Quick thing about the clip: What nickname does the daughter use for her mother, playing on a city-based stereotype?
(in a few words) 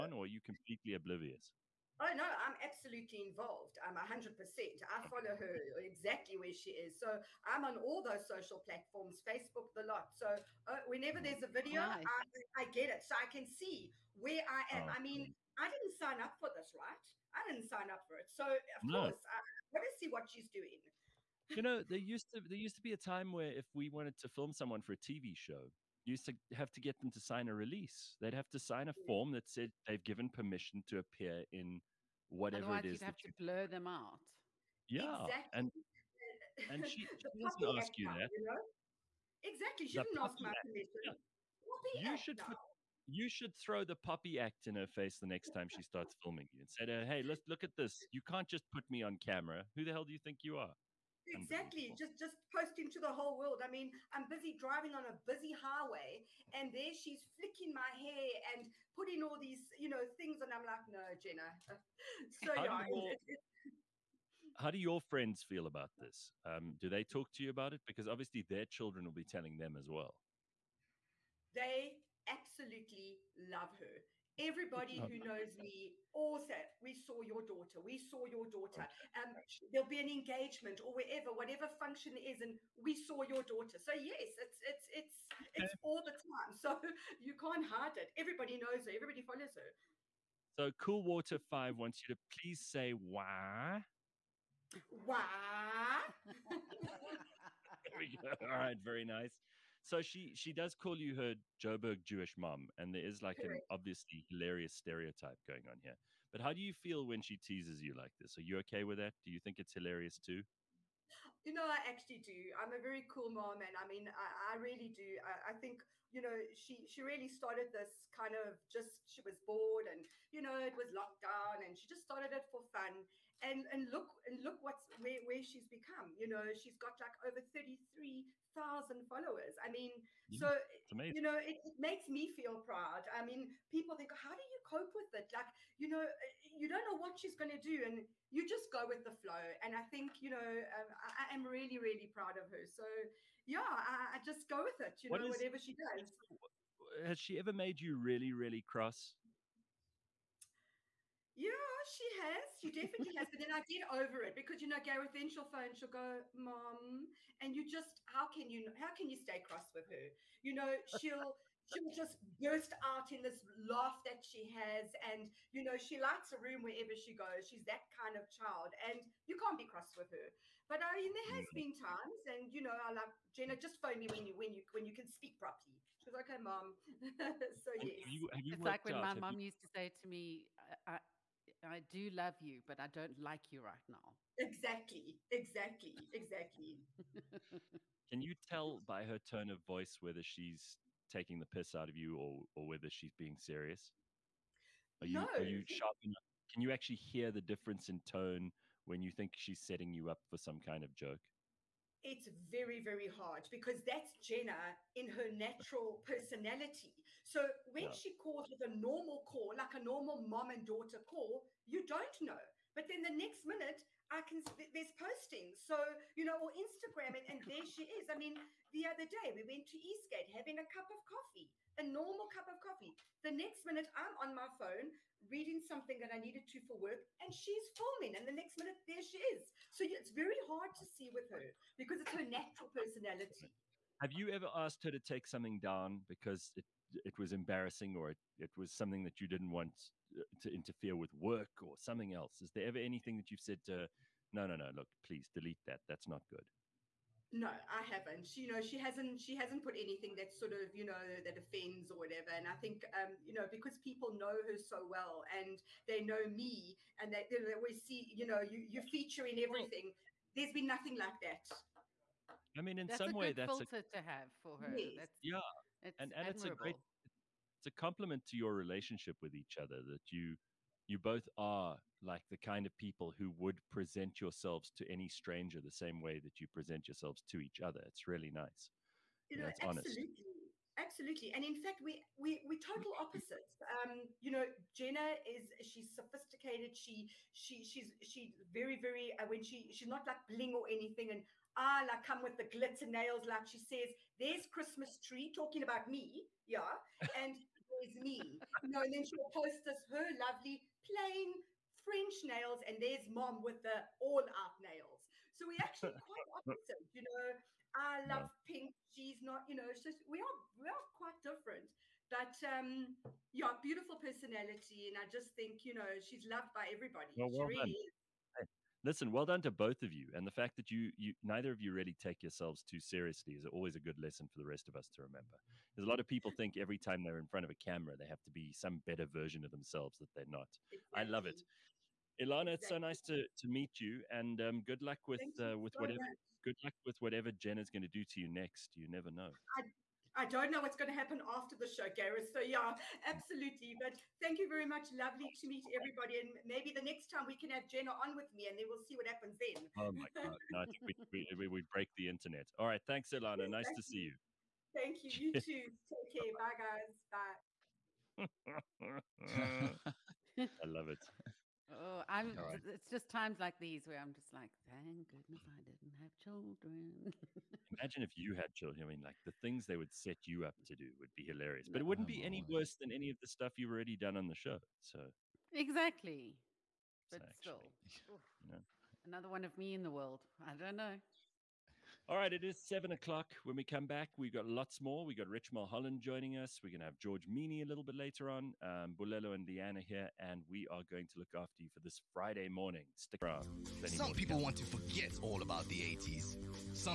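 Joburg Jewish mom.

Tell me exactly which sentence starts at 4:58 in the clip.
You know, and then she'll post us her lovely plain French nails, and there's mom with the all out nails.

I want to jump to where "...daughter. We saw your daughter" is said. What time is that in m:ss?
1:17.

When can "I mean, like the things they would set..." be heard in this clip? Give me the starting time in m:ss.
6:08.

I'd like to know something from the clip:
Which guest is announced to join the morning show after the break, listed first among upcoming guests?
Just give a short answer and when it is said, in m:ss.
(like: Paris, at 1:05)
Rich Mulholland, at 6:25.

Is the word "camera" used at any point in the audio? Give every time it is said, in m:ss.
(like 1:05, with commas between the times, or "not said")
0:49, 5:27.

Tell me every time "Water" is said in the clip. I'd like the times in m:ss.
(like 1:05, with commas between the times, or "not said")
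1:31.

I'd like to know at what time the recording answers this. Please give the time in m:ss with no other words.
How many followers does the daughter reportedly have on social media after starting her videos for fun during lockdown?
2:07.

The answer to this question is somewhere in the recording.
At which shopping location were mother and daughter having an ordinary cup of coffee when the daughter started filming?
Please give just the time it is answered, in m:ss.
3:39.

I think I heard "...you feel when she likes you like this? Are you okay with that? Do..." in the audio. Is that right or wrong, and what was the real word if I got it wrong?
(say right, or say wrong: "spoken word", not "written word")
wrong: "teases", not "likes".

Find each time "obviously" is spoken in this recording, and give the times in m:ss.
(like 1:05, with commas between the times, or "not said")
1:08, 1:43.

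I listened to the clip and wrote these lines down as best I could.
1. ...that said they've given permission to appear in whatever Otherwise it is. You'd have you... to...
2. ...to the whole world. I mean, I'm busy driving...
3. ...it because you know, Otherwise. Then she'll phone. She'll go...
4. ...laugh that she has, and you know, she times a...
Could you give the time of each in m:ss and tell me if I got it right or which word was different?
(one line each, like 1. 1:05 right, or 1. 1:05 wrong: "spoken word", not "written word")
1. 0:29 right
2. 0:52 right
3. 2:34 wrong: "Gareth", not "Otherwise"
4. 2:43 wrong: "likes", not "times".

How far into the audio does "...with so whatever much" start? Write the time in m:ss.
5:35.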